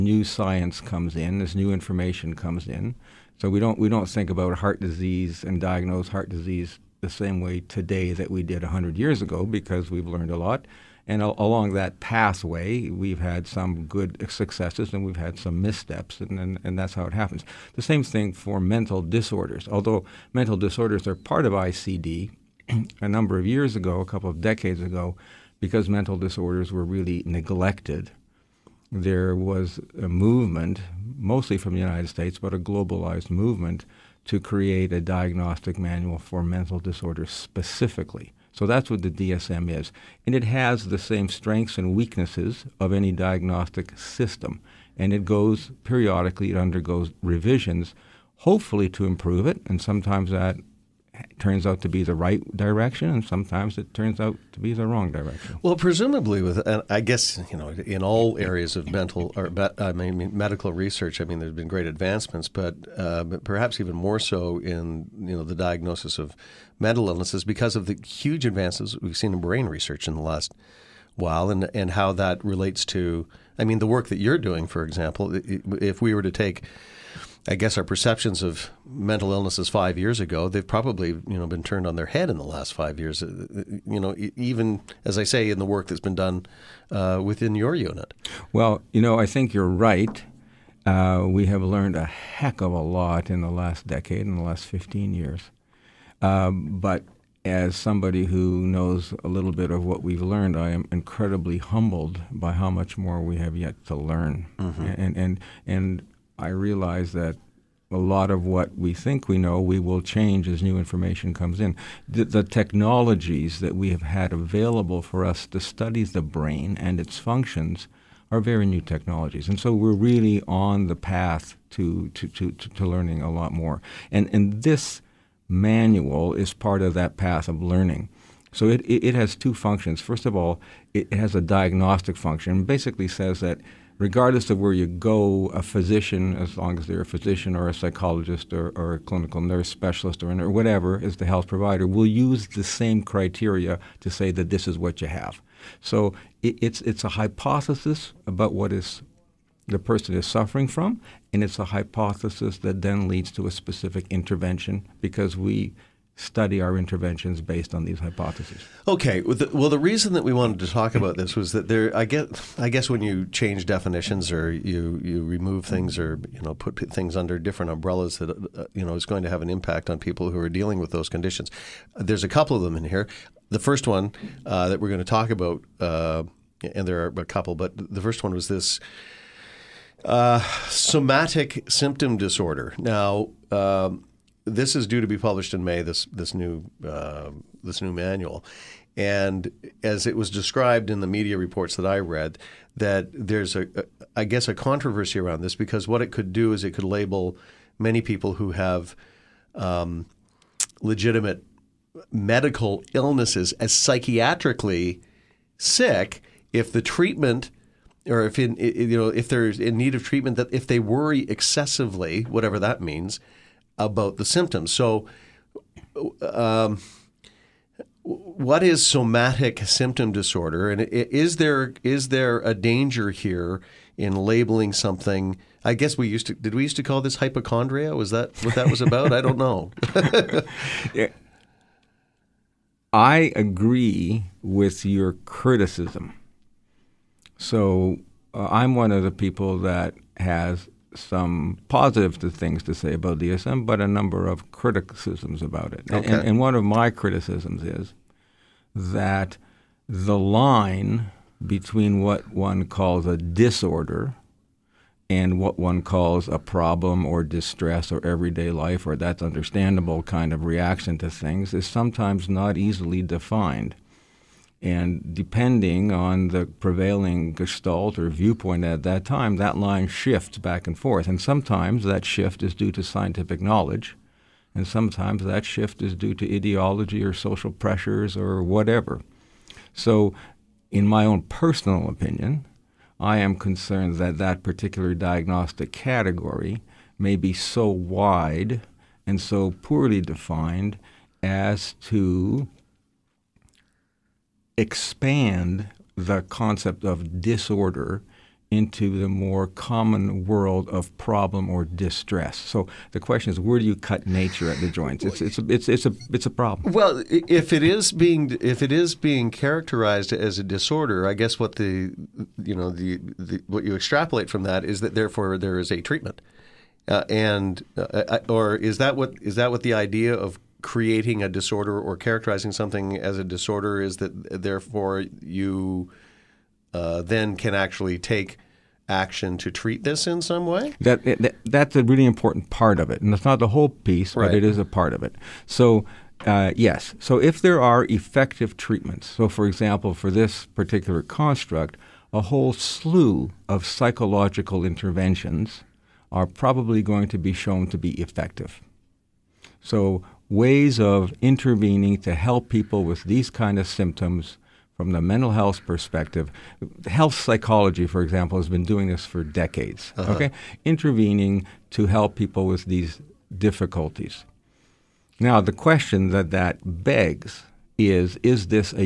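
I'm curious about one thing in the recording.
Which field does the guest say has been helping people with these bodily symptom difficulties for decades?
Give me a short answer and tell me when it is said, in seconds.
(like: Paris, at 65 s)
Health psychology, at 356 s.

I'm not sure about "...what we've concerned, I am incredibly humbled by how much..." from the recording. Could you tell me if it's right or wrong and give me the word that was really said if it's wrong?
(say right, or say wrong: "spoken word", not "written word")
wrong: "learned", not "concerned".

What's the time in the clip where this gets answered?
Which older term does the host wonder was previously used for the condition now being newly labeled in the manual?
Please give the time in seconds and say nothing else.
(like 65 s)
227 s.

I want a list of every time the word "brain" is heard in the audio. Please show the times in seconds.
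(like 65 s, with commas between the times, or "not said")
69 s, 116 s.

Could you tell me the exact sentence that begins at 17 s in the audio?
The same thing for mental disorders.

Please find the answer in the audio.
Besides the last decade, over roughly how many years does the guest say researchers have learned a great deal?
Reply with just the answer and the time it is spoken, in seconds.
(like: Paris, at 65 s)
15, at 94 s.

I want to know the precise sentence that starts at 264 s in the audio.
And depending on the prevailing gestalt or viewpoint at that time, that line shifts back and forth.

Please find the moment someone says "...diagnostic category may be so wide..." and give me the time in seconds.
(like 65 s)
284 s.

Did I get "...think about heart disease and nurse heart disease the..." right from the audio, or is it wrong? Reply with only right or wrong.
wrong.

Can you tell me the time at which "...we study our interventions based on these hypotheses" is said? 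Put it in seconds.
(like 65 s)
155 s.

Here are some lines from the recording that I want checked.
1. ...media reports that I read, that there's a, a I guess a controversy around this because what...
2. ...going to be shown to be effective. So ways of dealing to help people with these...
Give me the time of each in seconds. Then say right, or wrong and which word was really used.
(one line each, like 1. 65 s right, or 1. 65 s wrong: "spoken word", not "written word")
1. 191 s right
2. 346 s wrong: "intervening", not "dealing".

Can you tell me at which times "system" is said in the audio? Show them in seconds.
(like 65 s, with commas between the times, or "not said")
43 s.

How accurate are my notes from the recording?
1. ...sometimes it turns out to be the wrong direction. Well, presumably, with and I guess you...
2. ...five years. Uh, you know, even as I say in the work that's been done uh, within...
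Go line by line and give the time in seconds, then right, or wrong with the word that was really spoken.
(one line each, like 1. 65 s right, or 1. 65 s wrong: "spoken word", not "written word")
1. 53 s right
2. 82 s right.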